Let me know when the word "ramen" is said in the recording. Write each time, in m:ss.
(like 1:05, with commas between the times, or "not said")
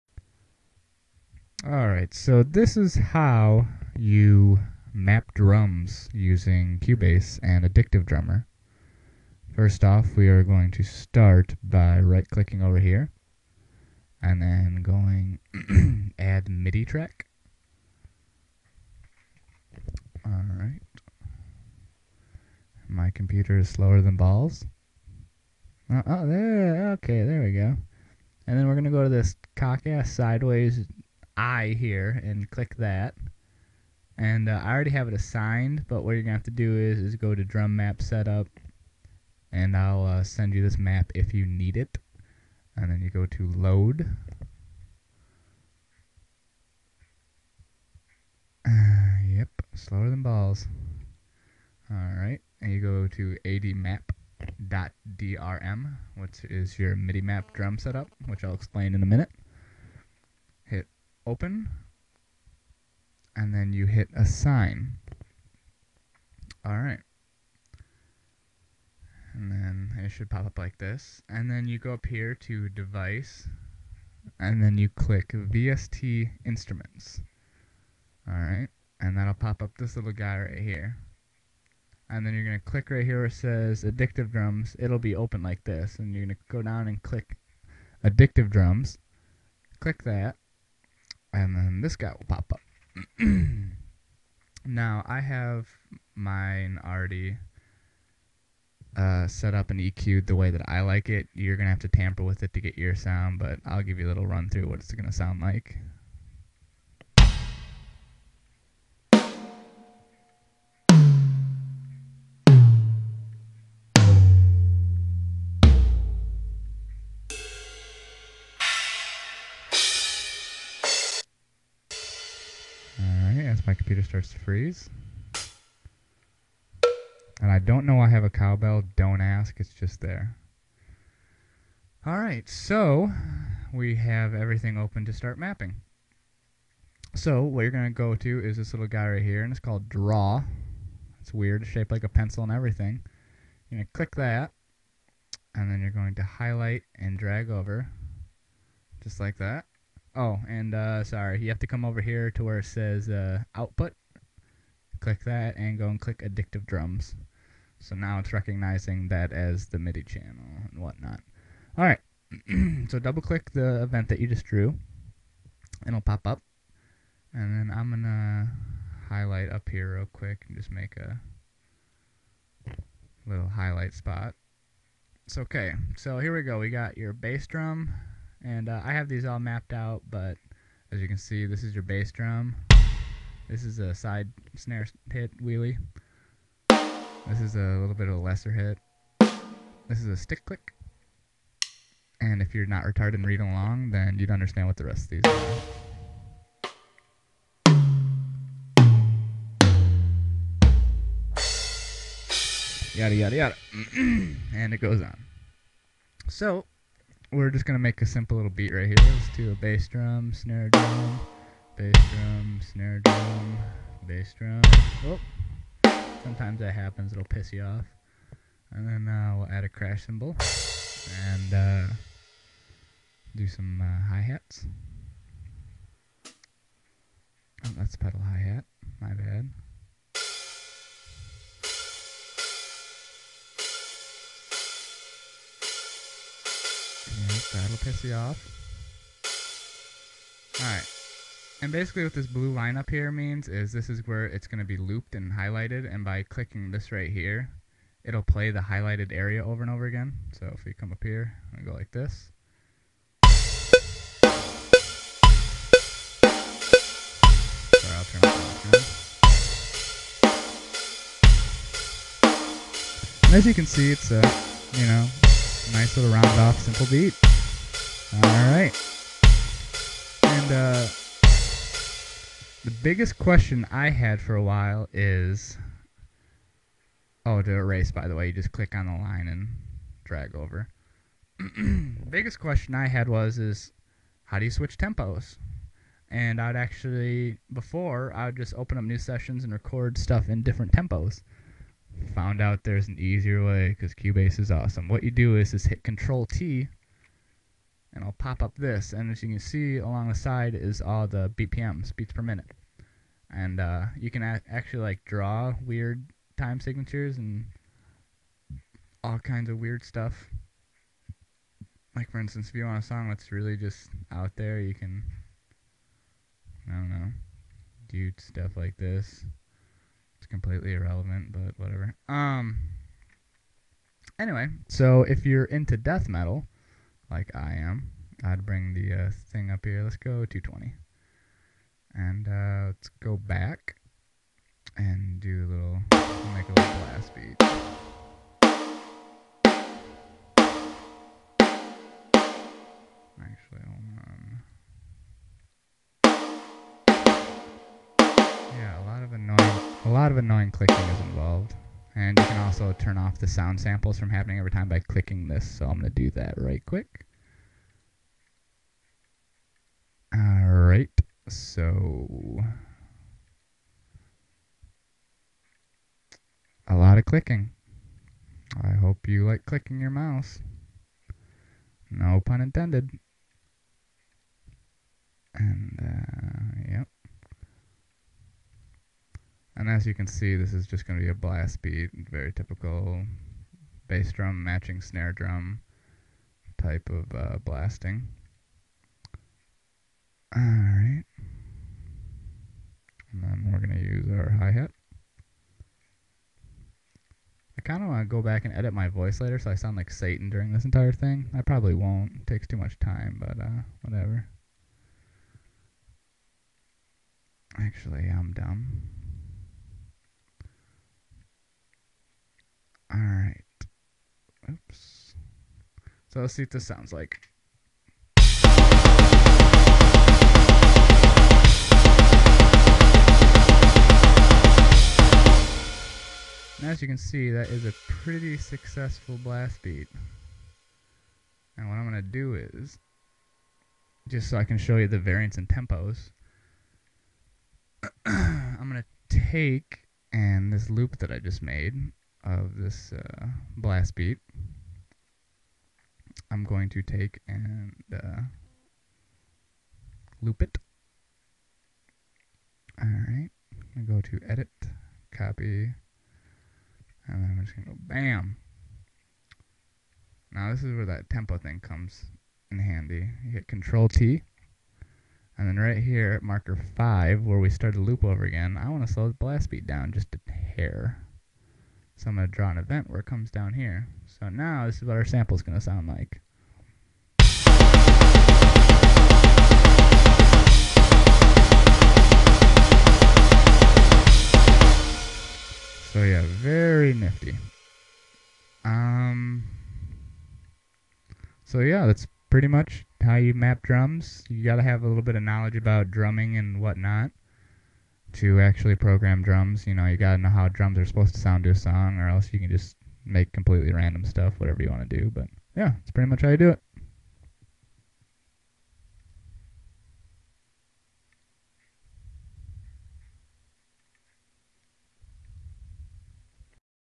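not said.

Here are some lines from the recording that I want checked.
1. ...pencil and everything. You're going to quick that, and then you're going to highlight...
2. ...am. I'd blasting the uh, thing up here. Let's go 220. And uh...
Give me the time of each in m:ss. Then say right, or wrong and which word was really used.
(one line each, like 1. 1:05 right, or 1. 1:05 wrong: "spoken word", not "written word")
1. 2:22 wrong: "click", not "quick"
2. 5:27 wrong: "bring", not "blasting".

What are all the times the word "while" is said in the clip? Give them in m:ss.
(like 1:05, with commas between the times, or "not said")
4:34.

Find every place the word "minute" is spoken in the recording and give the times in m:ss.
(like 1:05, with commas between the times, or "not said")
0:59, 5:02.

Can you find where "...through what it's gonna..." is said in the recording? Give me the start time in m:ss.
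1:44.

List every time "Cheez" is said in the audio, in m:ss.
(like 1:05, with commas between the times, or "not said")
not said.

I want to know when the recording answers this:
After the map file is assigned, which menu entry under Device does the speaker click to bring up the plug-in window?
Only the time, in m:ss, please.
1:15.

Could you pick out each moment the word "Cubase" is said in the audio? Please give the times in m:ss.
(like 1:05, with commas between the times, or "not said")
0:06, 4:53.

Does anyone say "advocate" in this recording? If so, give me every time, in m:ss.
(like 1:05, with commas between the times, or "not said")
not said.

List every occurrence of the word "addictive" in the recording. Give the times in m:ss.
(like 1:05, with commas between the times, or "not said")
0:07, 1:23, 1:28, 2:36.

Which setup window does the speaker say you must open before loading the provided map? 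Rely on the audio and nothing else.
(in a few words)
drum map setup.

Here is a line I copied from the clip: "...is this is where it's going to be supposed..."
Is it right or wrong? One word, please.
wrong.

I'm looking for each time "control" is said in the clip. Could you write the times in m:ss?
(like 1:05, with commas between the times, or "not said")
4:55, 7:43.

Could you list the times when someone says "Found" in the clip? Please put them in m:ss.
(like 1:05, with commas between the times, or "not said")
4:52.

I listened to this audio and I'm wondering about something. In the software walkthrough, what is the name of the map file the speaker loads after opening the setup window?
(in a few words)
admap.drm.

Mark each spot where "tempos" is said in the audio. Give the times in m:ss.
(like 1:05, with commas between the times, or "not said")
4:44, 4:50, 7:15, 7:41.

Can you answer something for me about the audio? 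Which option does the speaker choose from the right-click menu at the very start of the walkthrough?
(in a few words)
Add MIDI Track.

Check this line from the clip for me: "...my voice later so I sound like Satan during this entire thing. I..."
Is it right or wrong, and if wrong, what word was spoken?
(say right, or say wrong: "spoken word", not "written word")
right.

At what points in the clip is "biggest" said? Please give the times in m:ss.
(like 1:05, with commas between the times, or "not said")
4:32, 4:42.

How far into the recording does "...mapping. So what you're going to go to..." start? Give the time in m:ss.
2:15.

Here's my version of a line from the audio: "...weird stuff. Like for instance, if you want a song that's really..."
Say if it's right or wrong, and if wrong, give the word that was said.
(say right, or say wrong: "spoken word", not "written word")
right.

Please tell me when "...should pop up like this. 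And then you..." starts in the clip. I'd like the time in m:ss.
1:10.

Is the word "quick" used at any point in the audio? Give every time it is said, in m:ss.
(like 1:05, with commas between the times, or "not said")
2:50, 5:56.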